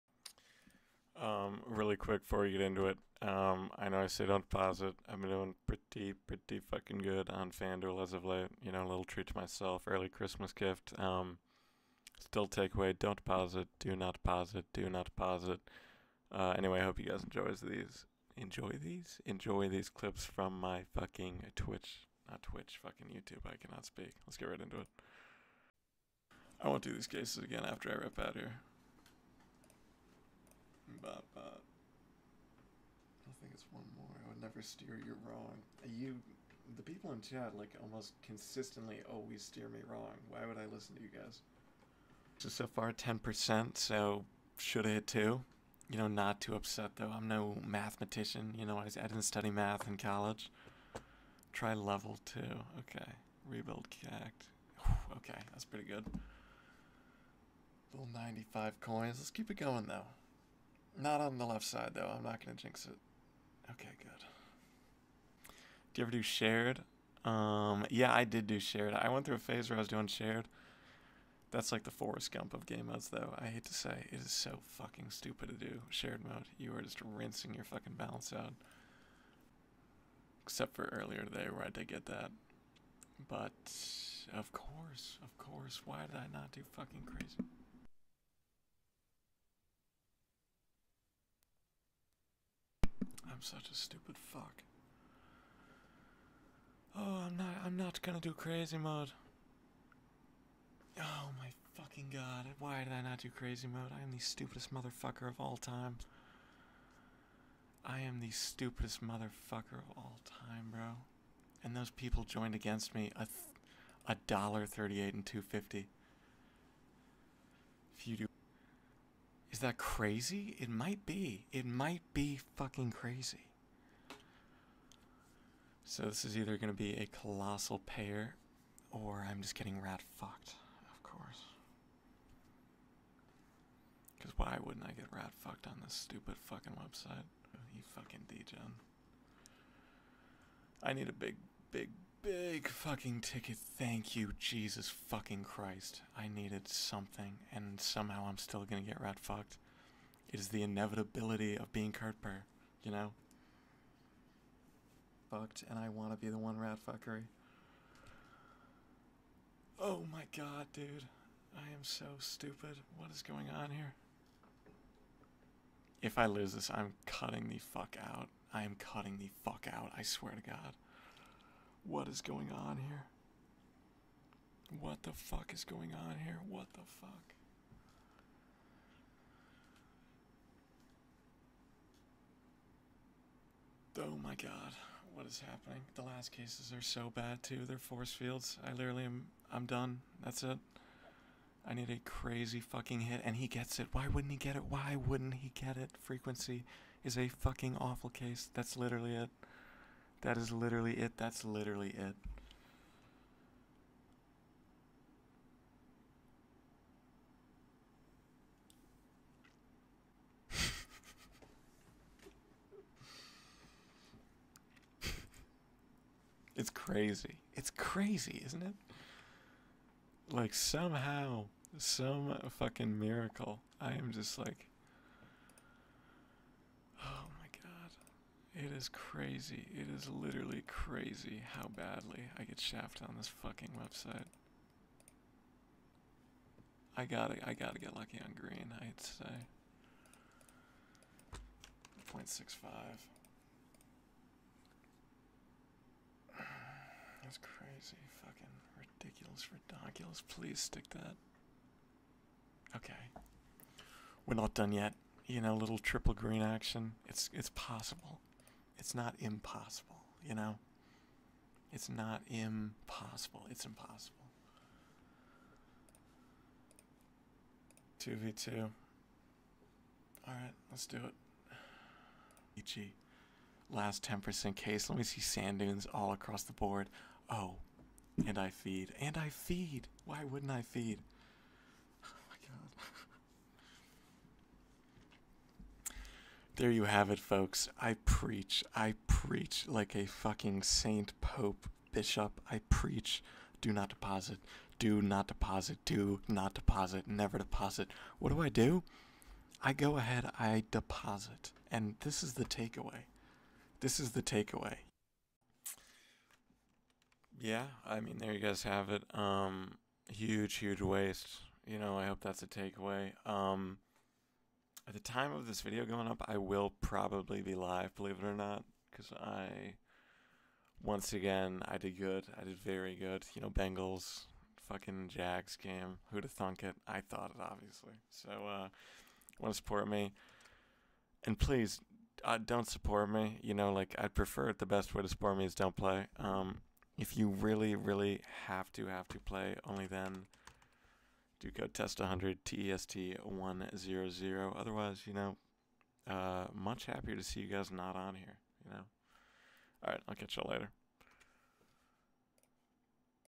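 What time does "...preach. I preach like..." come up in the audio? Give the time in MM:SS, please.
04:48.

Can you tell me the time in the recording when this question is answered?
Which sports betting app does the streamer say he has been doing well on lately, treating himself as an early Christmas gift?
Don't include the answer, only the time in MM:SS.
00:07.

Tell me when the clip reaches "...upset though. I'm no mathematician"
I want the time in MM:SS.
00:46.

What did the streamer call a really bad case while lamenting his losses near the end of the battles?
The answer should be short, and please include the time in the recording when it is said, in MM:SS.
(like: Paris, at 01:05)
Frequency, at 03:16.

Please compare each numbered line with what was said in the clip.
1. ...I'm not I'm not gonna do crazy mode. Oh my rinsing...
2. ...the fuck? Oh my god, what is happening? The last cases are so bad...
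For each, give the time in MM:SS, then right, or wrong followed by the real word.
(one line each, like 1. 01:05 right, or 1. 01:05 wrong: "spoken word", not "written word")
1. 01:37 wrong: "fucking", not "rinsing"
2. 02:56 right.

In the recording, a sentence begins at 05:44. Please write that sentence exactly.
Otherwise, you know, uh, much happier to see you guys not on here, you know.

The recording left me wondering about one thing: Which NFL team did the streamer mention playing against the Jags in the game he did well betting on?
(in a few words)
Bengals.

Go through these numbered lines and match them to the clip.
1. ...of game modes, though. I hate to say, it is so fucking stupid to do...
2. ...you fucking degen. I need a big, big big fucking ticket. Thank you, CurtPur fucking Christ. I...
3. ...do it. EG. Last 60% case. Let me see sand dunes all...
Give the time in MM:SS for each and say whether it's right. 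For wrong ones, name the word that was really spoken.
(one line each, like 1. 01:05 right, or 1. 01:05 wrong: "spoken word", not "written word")
1. 01:12 right
2. 02:17 wrong: "Jesus", not "CurtPur"
3. 04:30 wrong: "10", not "60".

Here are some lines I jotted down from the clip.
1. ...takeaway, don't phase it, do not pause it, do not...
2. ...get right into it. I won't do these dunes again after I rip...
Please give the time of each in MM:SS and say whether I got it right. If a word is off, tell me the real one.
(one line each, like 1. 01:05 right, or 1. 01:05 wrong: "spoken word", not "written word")
1. 00:12 wrong: "pause", not "phase"
2. 00:24 wrong: "cases", not "dunes".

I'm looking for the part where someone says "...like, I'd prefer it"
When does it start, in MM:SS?
05:33.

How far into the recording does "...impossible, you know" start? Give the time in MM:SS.
04:19.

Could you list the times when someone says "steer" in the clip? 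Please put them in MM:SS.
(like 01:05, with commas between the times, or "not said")
00:34, 00:39.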